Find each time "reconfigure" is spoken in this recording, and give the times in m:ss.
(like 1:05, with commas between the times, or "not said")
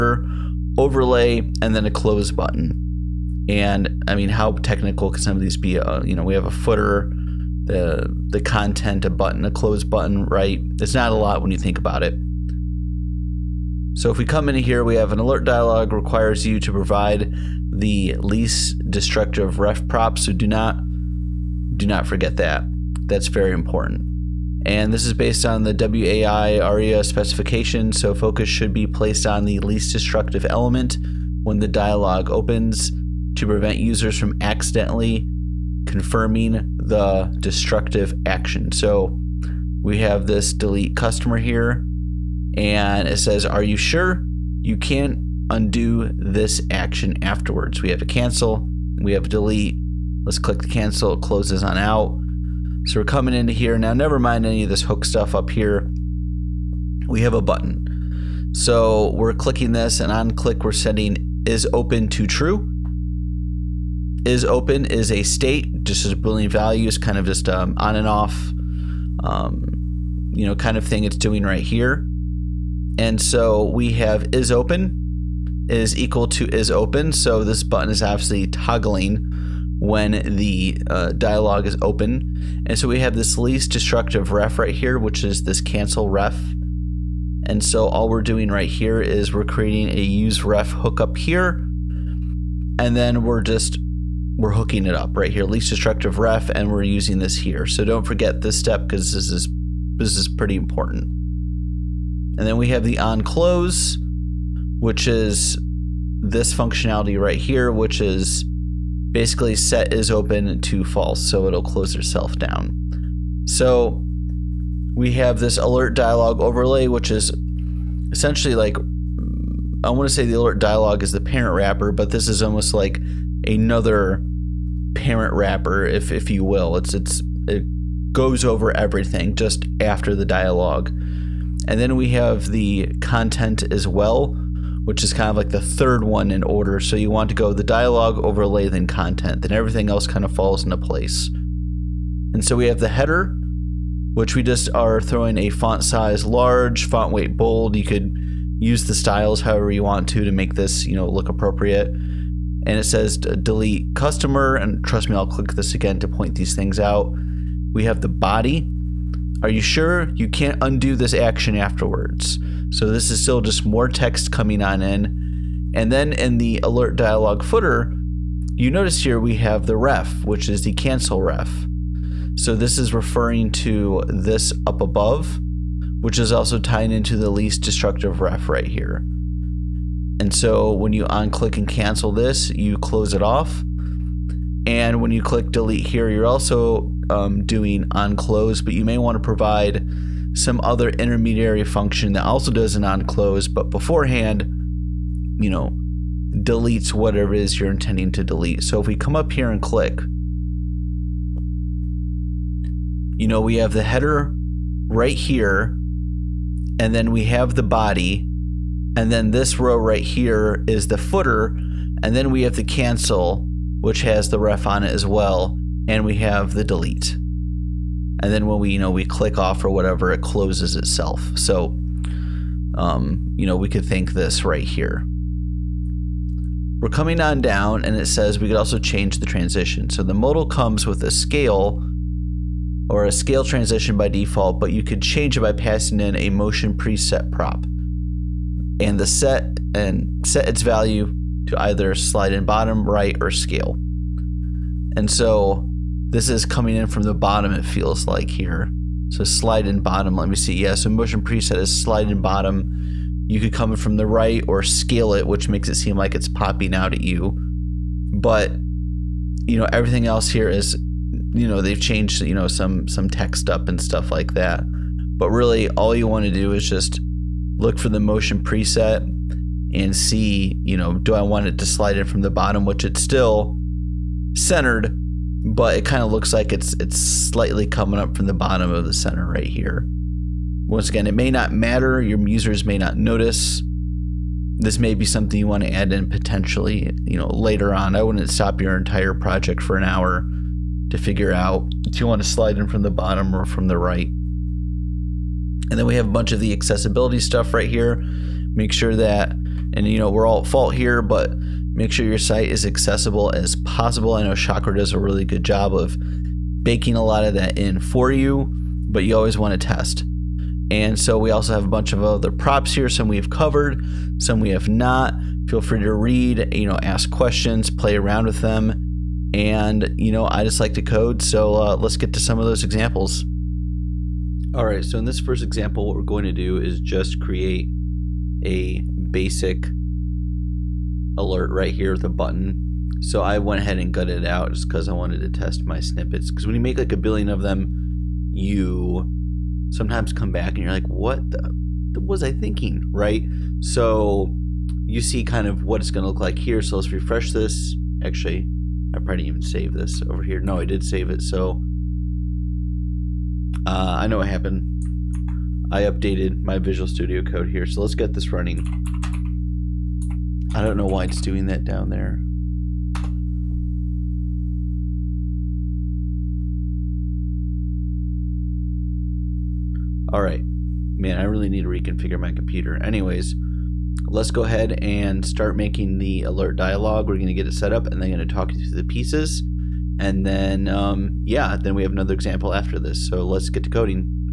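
6:11.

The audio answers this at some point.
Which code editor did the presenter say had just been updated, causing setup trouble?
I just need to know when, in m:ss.
5:56.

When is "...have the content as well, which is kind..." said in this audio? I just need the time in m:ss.
2:12.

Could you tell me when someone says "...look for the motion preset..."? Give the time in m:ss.
4:27.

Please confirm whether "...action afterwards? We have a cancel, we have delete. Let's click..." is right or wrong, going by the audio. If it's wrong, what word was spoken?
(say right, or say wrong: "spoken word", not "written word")
right.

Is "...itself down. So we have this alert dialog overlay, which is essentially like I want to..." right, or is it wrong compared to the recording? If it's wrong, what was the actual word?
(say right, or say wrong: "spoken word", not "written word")
right.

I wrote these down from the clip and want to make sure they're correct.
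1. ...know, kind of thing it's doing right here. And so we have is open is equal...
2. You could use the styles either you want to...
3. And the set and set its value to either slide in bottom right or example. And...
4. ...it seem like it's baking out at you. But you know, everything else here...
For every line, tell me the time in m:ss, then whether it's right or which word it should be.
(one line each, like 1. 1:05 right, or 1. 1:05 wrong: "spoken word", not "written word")
1. 1:10 right
2. 2:27 wrong: "however", not "either"
3. 3:58 wrong: "scale", not "example"
4. 4:15 wrong: "popping", not "baking".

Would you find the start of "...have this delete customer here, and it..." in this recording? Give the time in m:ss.
0:39.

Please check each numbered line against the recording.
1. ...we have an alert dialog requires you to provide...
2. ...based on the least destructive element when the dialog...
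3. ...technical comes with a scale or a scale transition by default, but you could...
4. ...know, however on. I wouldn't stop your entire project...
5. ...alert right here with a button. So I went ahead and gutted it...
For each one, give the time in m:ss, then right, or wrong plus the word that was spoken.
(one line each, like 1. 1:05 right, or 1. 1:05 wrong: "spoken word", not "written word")
1. 0:14 right
2. 0:28 wrong: "placed", not "based"
3. 3:50 wrong: "modal", not "technical"
4. 4:47 wrong: "later", not "however"
5. 5:31 right.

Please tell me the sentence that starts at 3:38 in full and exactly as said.
And then when we, you know, we click off or whatever, it closes itself.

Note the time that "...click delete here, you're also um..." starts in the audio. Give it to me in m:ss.
3:05.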